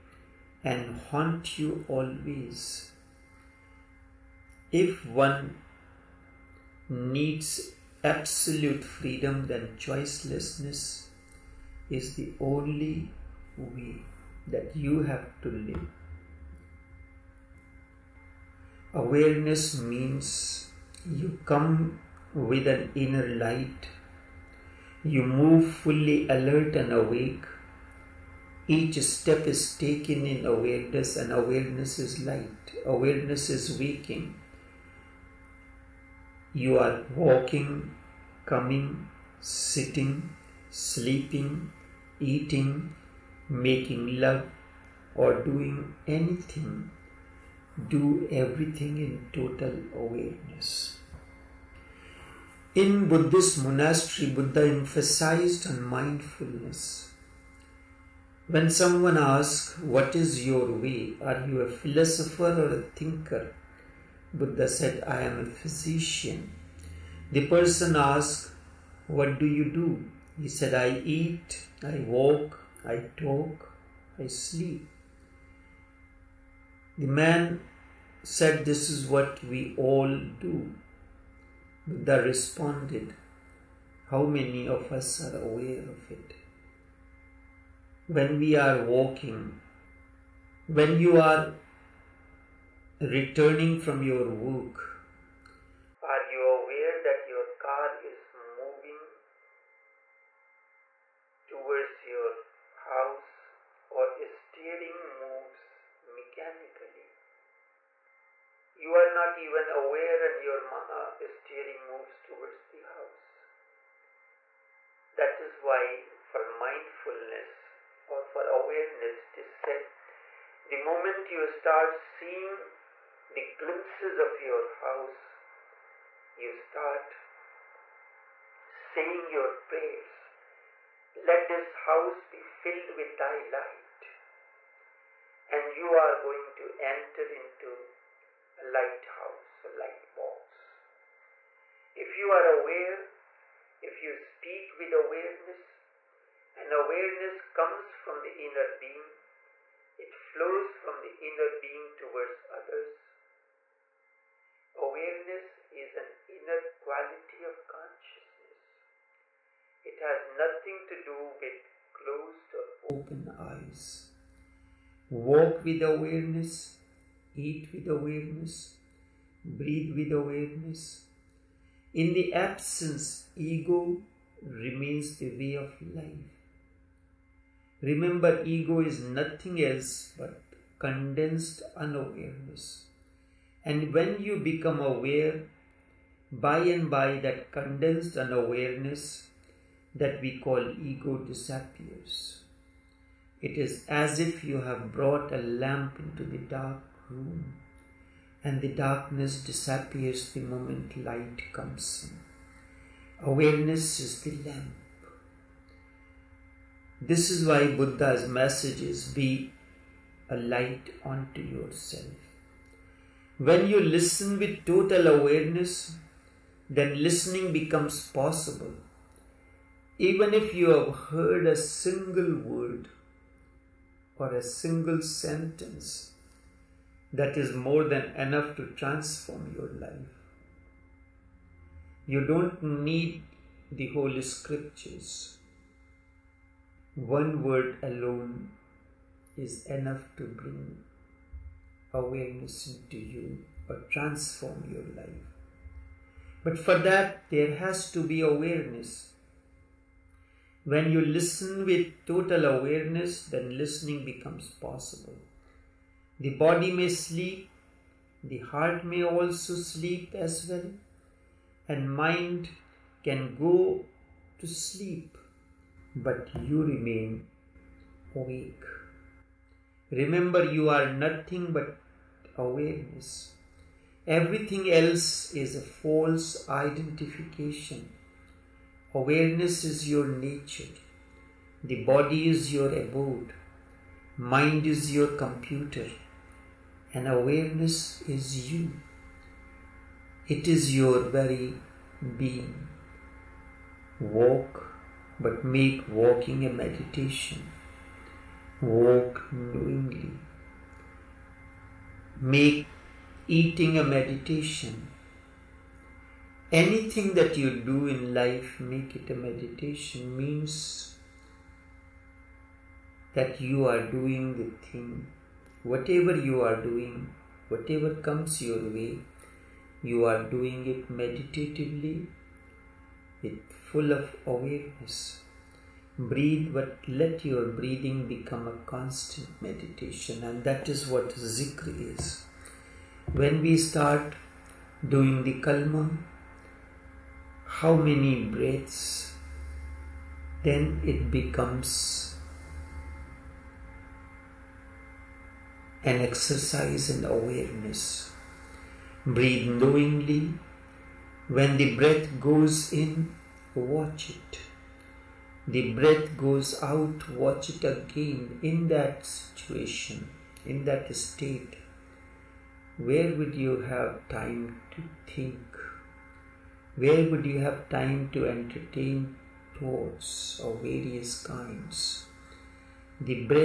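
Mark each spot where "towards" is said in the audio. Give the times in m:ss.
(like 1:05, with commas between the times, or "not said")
1:41, 1:52, 2:31.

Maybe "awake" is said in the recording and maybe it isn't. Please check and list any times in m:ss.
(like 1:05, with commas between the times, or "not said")
0:26, 4:28.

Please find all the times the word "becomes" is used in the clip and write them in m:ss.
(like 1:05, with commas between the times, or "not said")
3:04, 3:37, 4:14, 5:28, 5:41.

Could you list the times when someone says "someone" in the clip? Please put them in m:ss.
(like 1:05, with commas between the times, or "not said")
0:58.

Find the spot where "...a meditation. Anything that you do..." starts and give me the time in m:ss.
5:03.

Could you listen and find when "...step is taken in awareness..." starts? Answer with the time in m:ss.
0:29.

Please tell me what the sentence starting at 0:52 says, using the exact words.
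In Buddhist monastery, Buddha emphasized on mindfulness.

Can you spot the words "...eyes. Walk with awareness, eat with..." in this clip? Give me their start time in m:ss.
2:43.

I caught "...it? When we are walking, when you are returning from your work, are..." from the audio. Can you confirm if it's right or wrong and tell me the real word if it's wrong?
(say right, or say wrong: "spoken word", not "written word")
right.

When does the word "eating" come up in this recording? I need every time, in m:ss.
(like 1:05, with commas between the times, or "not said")
0:42, 5:03.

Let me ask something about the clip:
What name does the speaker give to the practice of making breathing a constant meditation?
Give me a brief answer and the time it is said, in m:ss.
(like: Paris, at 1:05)
Zikr, at 5:31.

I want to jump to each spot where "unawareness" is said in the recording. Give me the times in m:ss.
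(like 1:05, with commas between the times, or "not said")
3:01, 3:08.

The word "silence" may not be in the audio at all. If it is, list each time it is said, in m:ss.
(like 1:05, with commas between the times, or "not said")
not said.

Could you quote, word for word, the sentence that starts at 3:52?
You don't need the Holy Scriptures one word alone is enough to bring awareness into you or transform your life.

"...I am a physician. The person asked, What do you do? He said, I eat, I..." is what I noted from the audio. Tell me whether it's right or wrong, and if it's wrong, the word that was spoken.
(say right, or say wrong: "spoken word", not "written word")
right.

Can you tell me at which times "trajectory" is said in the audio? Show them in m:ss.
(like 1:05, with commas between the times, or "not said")
not said.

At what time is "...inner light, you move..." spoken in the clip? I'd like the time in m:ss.
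0:22.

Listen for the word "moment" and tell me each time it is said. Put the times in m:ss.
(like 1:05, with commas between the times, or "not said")
2:00, 3:20.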